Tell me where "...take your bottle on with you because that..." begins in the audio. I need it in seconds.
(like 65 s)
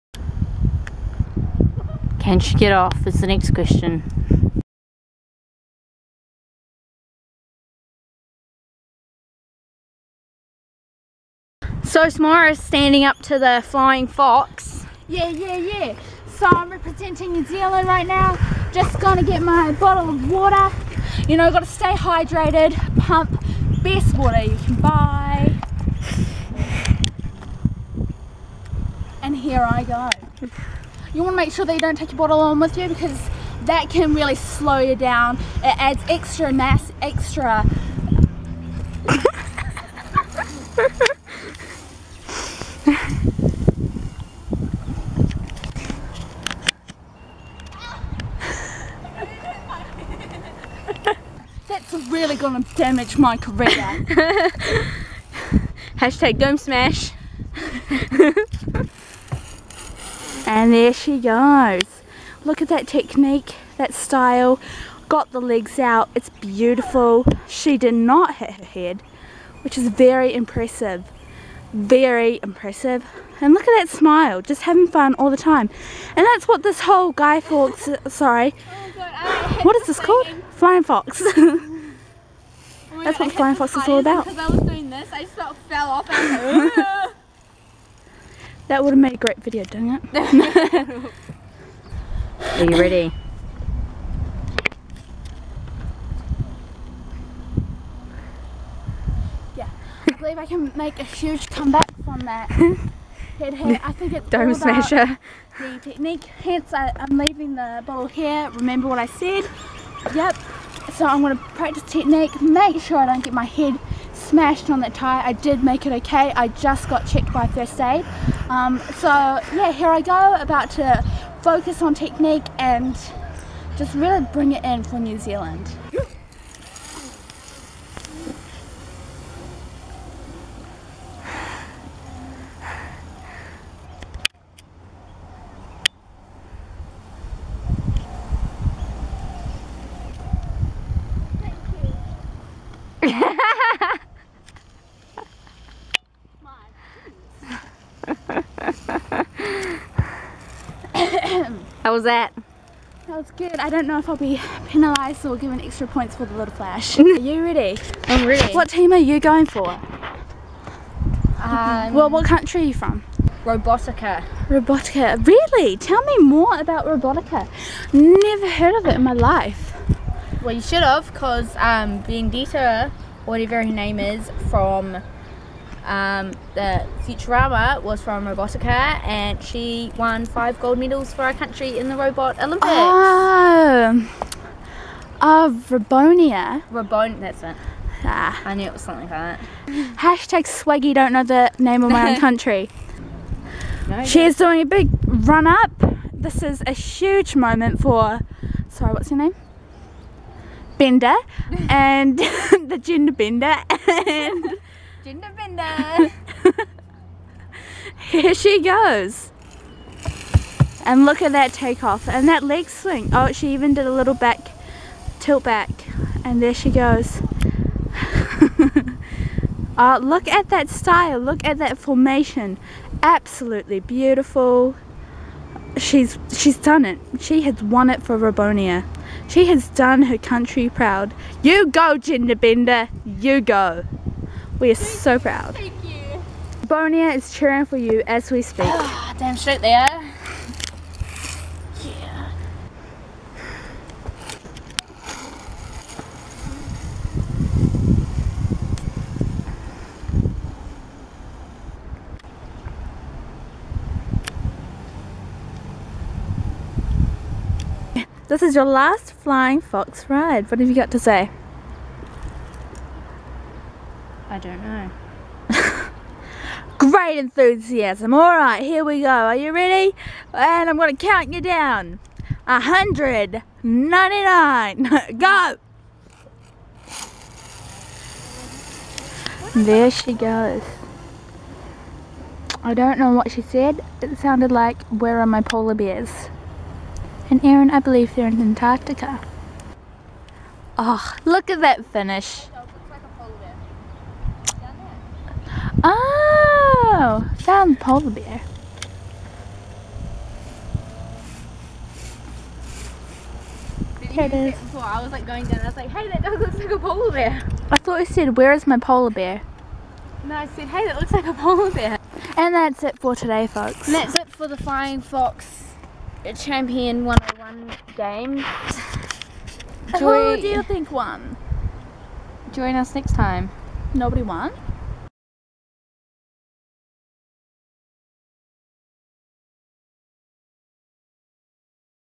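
31 s.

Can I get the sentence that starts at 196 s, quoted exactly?
This is a huge moment for, sorry, what's your name?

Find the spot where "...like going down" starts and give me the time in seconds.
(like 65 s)
305 s.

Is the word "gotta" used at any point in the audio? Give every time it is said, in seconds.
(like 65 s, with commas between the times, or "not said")
21 s.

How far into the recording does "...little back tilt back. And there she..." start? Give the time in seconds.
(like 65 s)
213 s.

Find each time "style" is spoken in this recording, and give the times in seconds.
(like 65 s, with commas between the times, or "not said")
63 s, 220 s.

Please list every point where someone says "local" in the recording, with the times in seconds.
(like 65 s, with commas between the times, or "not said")
not said.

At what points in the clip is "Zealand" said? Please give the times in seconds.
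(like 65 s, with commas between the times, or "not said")
17 s, 125 s.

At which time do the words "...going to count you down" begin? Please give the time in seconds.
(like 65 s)
270 s.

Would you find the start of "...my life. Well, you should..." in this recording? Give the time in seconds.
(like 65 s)
169 s.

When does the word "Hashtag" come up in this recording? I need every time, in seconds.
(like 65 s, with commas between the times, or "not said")
55 s, 189 s.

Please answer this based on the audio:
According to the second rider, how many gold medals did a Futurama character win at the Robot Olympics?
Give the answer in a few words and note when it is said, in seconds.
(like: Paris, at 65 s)
5, at 180 s.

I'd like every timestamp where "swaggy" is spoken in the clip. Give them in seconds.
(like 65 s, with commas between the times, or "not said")
190 s.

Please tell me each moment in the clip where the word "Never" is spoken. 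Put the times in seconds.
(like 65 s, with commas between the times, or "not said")
167 s.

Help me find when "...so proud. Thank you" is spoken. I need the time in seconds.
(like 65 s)
234 s.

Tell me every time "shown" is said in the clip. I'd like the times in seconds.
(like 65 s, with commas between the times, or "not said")
not said.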